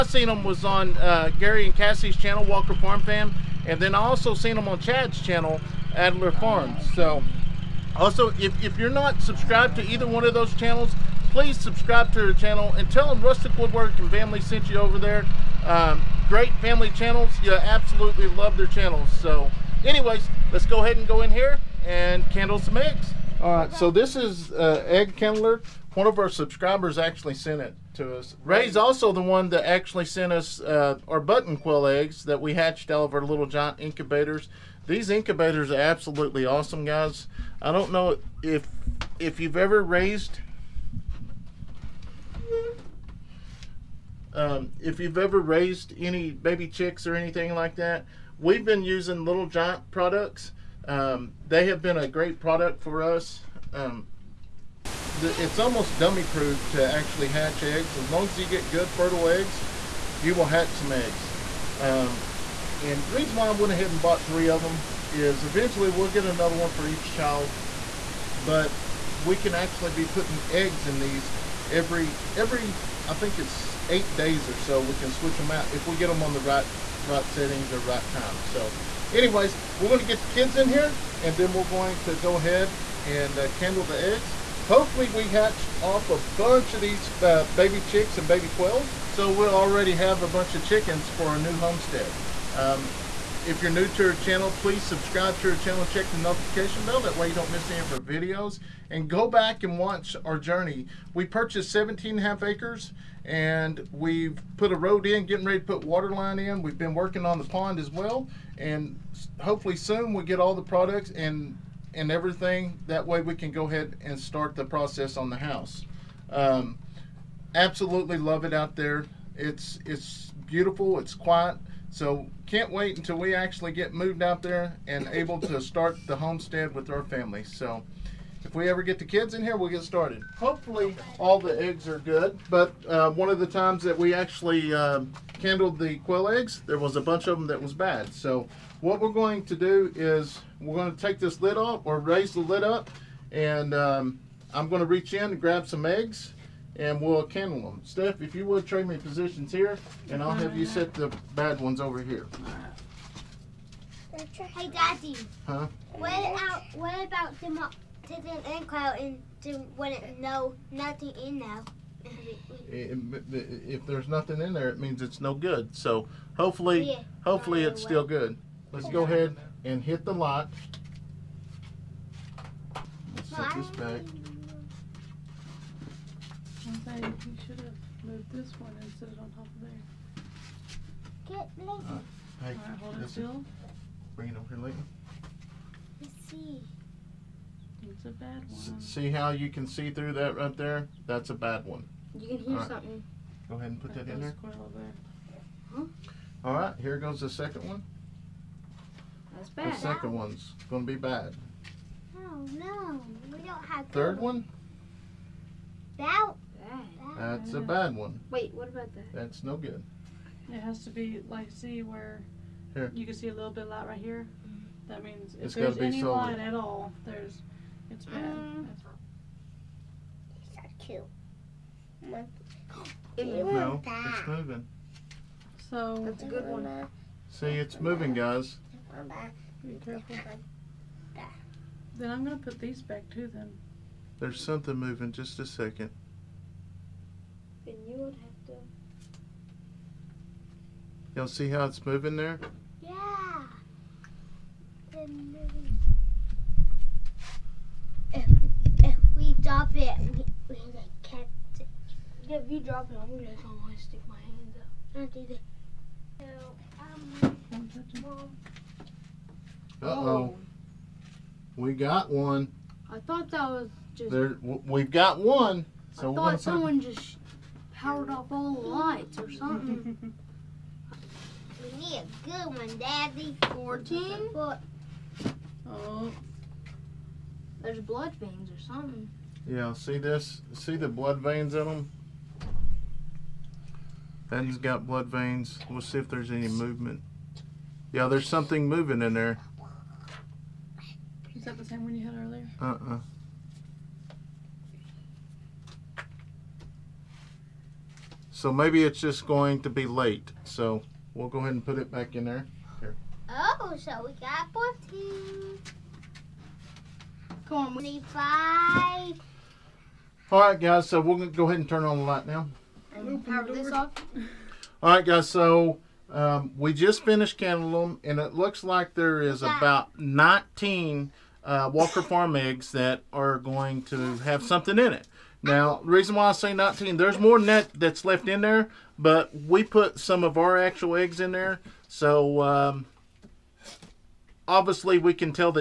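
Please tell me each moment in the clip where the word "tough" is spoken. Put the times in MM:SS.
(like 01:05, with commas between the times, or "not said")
not said.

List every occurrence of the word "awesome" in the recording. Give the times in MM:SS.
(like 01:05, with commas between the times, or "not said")
00:36.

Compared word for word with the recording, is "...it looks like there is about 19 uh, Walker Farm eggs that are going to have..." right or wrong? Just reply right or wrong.
right.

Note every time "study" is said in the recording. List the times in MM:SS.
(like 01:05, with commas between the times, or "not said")
not said.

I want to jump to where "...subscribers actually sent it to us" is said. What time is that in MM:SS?
00:26.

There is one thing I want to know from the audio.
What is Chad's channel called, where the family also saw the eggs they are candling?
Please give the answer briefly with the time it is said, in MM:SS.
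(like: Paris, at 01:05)
Adler Farms, at 00:05.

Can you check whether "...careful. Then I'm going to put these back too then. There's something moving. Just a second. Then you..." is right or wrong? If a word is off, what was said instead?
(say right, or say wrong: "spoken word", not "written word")
right.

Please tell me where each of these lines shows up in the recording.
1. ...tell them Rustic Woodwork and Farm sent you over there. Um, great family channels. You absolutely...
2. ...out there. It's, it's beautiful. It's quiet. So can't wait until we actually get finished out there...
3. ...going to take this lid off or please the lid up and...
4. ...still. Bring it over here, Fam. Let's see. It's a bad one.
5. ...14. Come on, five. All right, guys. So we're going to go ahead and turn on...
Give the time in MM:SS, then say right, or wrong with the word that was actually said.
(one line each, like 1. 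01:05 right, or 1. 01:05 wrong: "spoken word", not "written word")
1. 00:12 wrong: "Family", not "Farm"
2. 01:58 wrong: "moved", not "finished"
3. 02:20 wrong: "raise", not "please"
4. 03:03 wrong: "Leighton", not "Fam"
5. 05:04 right.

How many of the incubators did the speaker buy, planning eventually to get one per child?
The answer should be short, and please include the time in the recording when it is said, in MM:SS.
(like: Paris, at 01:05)
3, at 01:04.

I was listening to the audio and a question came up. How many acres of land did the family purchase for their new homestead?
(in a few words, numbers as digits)
17 and a half.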